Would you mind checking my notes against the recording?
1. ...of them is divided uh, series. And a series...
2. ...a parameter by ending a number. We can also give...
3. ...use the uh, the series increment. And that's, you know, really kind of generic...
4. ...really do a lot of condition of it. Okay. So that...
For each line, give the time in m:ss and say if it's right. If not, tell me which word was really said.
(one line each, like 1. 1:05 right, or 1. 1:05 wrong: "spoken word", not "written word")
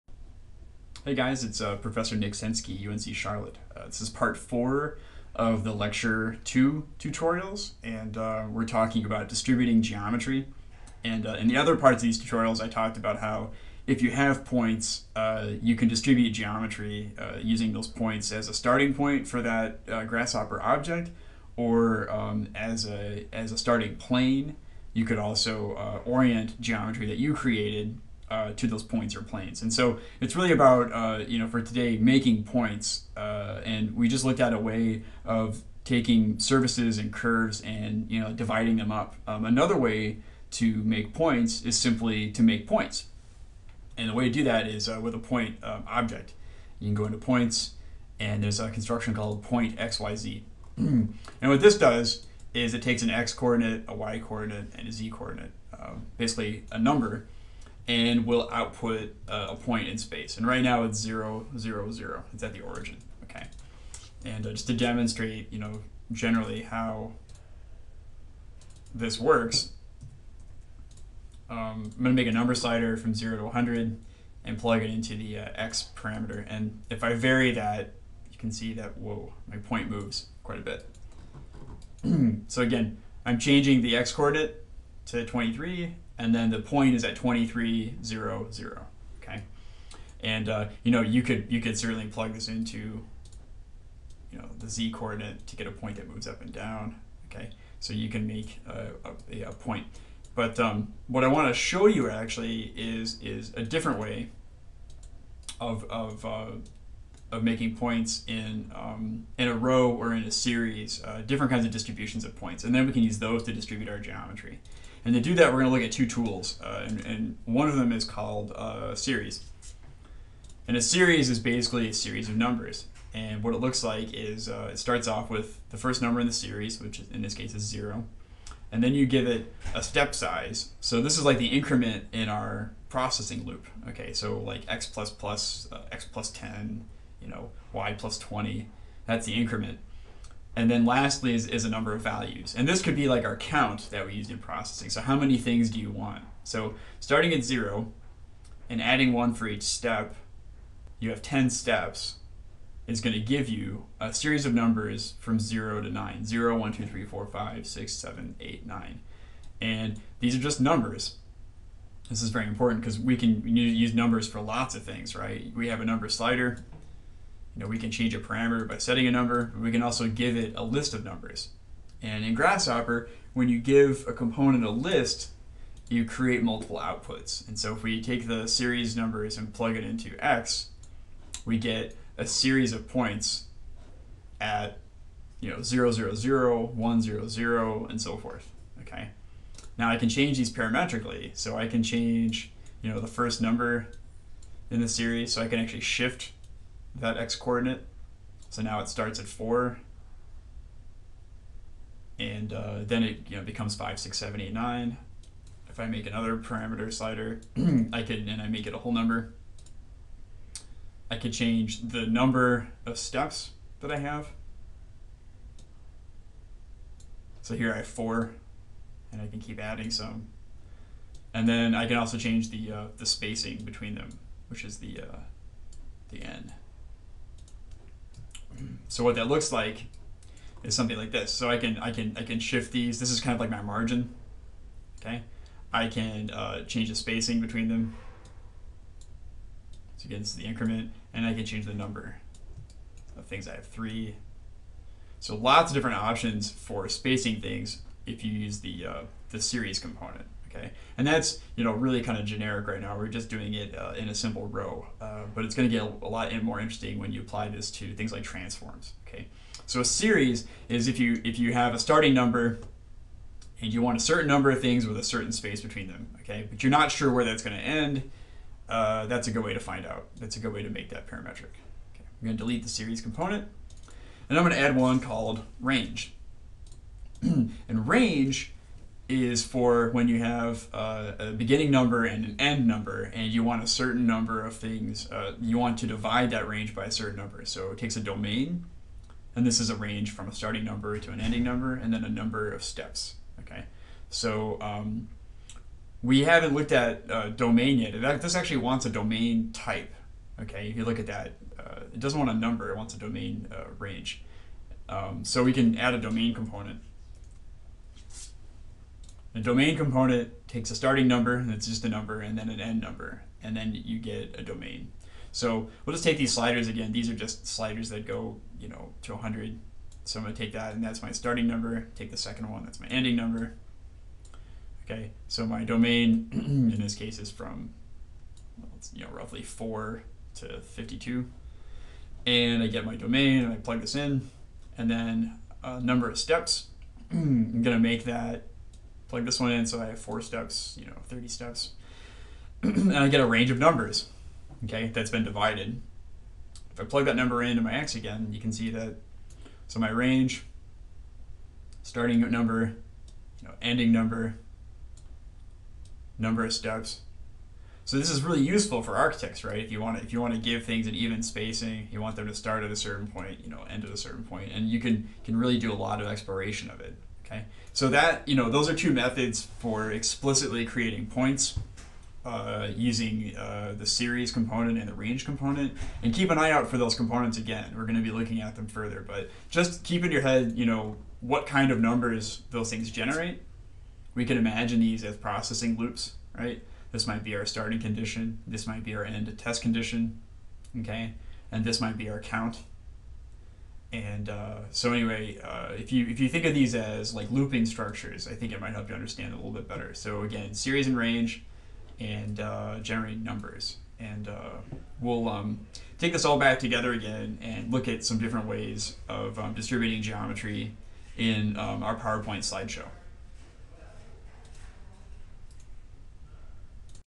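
1. 1:57 wrong: "called", not "divided"
2. 2:48 wrong: "setting", not "ending"
3. 4:08 wrong: "component", not "increment"
4. 6:05 wrong: "exploration", not "condition".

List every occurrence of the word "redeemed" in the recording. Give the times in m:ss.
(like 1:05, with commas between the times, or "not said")
not said.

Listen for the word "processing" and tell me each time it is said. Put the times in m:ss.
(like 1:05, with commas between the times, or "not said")
2:12, 2:24, 6:25.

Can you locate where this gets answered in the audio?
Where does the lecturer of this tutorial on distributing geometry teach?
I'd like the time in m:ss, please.
0:02.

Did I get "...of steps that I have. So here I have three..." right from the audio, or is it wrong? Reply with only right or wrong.
wrong.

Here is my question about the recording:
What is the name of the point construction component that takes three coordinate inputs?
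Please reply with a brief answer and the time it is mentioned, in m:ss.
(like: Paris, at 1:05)
point xyz, at 0:49.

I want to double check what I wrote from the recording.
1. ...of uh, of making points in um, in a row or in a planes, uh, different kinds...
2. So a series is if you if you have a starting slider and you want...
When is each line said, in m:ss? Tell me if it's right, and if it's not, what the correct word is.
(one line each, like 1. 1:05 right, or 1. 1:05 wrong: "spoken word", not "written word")
1. 1:45 wrong: "series", not "planes"
2. 4:19 wrong: "number", not "slider".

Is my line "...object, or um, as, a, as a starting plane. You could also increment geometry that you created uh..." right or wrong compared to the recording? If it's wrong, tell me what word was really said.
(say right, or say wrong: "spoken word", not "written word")
wrong: "orient", not "increment".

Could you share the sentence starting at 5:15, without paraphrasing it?
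So we'll just take these sliders again.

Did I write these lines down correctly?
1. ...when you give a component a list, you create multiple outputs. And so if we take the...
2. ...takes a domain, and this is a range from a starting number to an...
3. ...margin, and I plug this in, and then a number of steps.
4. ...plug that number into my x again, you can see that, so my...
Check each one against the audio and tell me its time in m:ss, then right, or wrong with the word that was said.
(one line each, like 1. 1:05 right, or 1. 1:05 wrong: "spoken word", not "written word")
1. 2:53 right
2. 4:47 right
3. 5:32 wrong: "domain", not "margin"
4. 5:46 right.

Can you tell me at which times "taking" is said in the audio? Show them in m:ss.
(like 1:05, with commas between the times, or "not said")
0:35.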